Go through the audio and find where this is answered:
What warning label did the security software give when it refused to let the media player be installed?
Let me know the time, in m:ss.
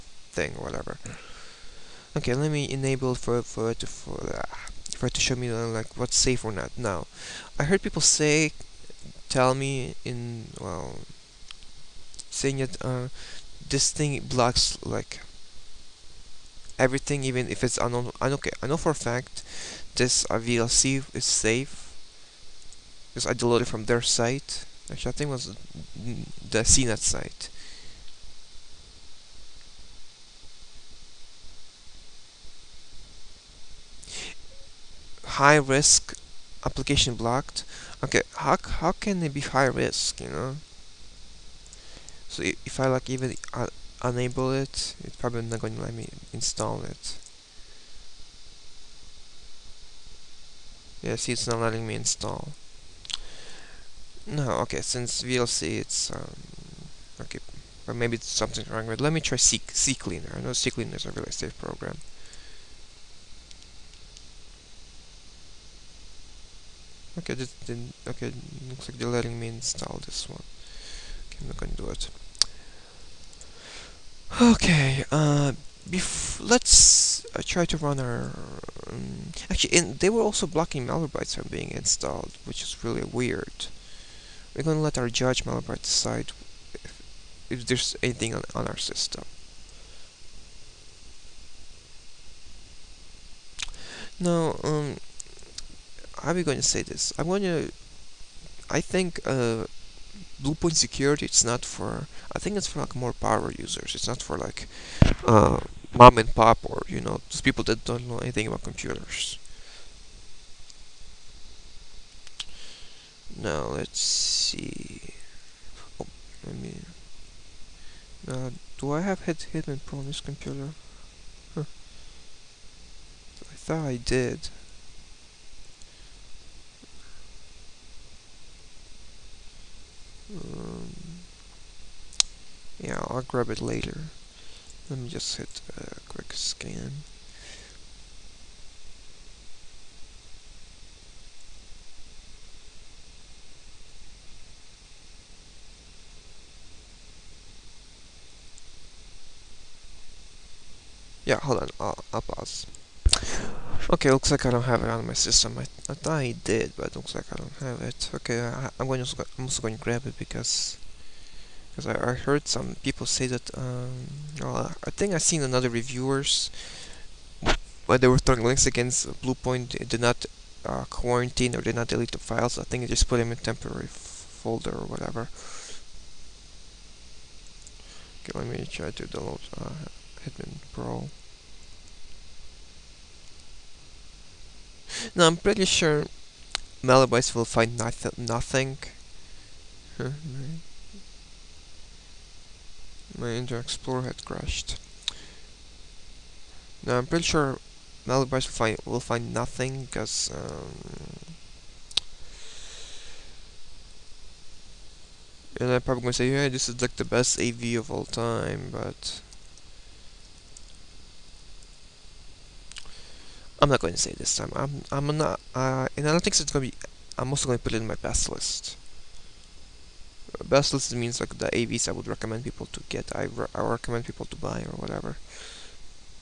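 0:35.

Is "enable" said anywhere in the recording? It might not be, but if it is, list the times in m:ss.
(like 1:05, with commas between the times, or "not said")
0:02, 0:44.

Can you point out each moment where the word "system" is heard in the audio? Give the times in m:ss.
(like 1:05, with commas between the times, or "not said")
1:28, 2:35.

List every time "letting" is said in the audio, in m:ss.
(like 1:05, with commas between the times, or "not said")
0:51, 1:09.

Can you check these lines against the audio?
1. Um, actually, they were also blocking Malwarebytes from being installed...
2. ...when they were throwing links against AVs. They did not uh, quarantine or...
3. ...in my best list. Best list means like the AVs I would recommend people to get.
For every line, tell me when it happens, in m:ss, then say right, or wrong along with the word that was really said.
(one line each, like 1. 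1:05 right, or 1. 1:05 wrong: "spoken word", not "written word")
1. 1:18 right
2. 2:47 wrong: "Bluepoint", not "AVs"
3. 3:37 right.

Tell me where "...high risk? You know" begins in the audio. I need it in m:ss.
0:39.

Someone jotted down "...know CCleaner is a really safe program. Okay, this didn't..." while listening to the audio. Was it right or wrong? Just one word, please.
right.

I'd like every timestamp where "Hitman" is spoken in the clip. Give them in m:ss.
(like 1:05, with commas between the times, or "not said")
1:59, 3:00.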